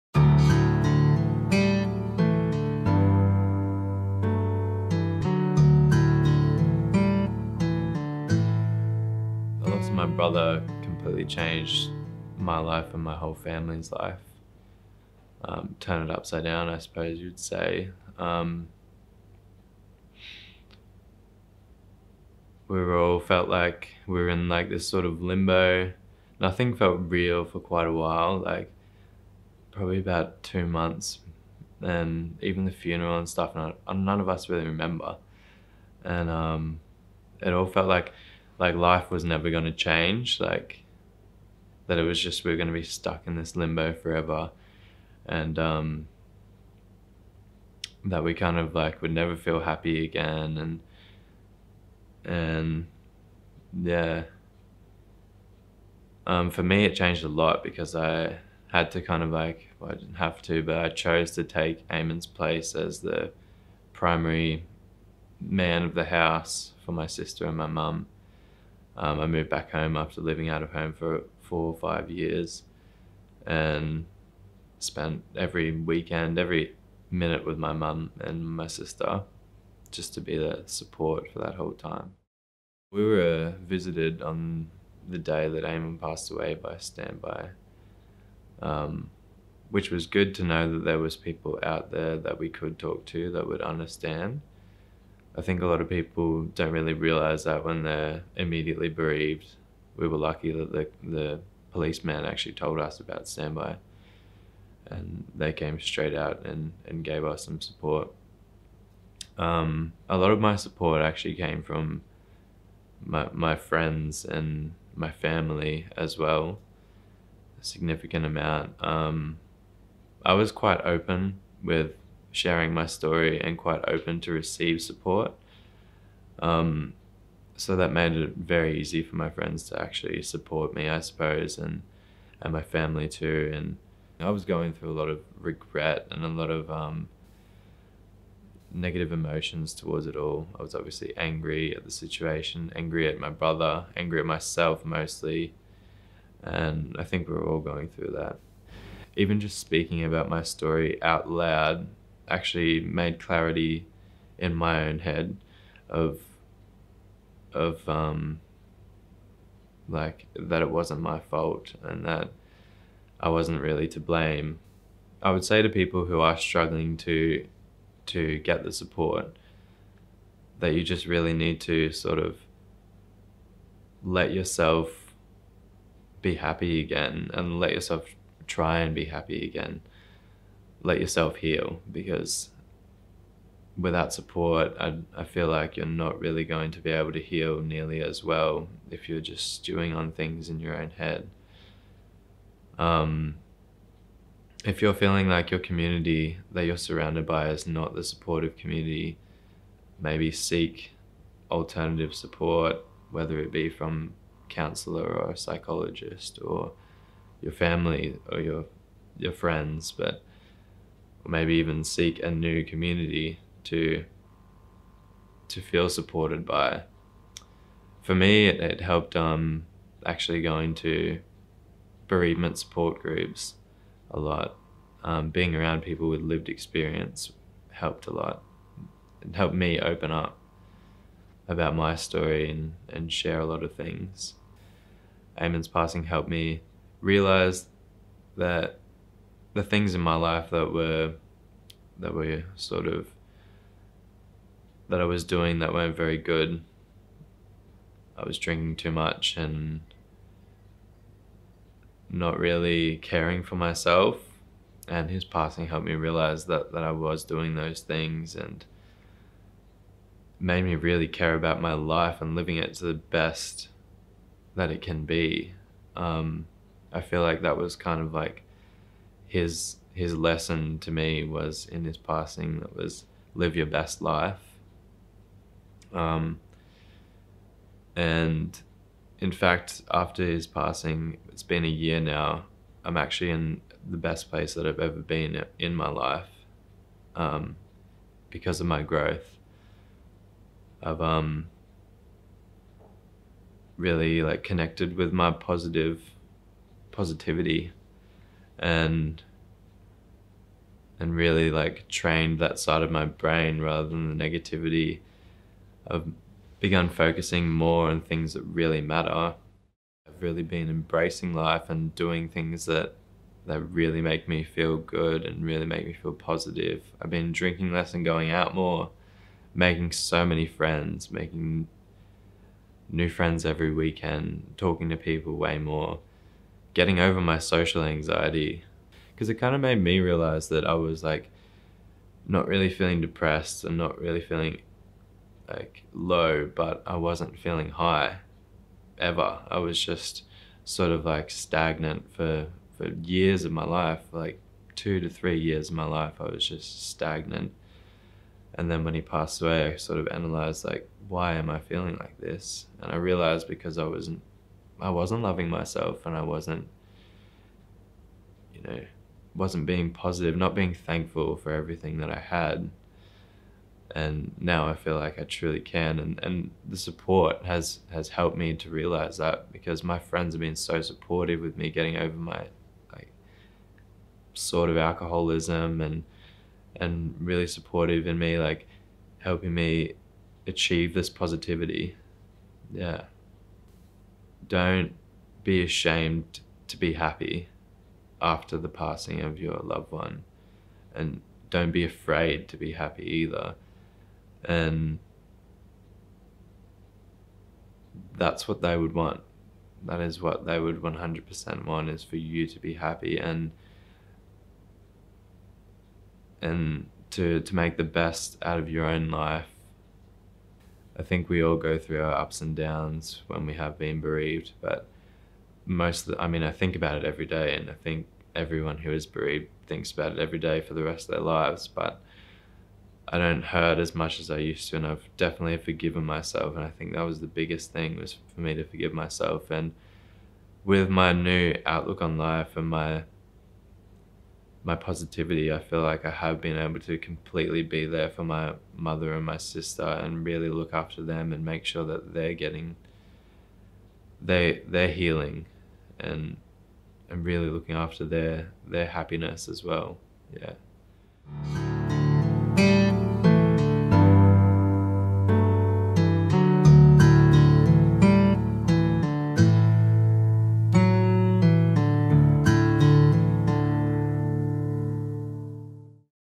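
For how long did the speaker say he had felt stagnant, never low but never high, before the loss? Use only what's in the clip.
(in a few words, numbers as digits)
2 to 3 years.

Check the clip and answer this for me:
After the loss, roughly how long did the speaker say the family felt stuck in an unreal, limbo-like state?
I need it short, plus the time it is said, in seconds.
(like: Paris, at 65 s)
about 2 months, at 29 s.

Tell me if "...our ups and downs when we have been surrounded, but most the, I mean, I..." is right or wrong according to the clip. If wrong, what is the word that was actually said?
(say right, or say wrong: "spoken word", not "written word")
wrong: "bereaved", not "surrounded".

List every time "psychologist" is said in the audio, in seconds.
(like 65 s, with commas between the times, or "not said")
205 s.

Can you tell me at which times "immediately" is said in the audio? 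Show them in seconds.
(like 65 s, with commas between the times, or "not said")
98 s.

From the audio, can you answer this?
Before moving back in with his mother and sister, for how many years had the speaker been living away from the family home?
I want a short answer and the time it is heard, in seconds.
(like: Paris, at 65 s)
4 or 5 years, at 71 s.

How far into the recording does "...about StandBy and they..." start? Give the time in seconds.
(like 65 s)
102 s.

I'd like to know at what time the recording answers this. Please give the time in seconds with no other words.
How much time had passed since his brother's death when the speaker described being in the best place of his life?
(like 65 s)
281 s.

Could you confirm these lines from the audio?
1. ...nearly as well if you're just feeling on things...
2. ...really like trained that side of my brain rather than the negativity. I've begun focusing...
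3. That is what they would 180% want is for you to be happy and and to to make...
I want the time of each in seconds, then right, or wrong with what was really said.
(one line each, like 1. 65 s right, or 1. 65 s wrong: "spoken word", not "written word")
1. 187 s wrong: "stewing", not "feeling"
2. 301 s right
3. 399 s wrong: "100", not "180".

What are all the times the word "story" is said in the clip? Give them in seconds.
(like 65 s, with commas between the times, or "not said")
122 s, 150 s, 231 s.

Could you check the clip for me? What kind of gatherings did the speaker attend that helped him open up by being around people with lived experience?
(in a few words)
bereavement support groups.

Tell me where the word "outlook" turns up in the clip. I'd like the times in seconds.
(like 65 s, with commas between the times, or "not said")
431 s.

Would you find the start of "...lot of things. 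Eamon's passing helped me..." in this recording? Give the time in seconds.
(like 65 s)
233 s.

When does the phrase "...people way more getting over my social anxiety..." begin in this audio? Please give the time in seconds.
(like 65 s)
324 s.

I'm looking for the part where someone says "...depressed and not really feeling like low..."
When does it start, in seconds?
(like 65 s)
333 s.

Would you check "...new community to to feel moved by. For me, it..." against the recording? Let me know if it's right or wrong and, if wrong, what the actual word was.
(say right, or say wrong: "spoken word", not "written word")
wrong: "supported", not "moved".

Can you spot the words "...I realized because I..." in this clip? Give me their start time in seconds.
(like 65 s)
352 s.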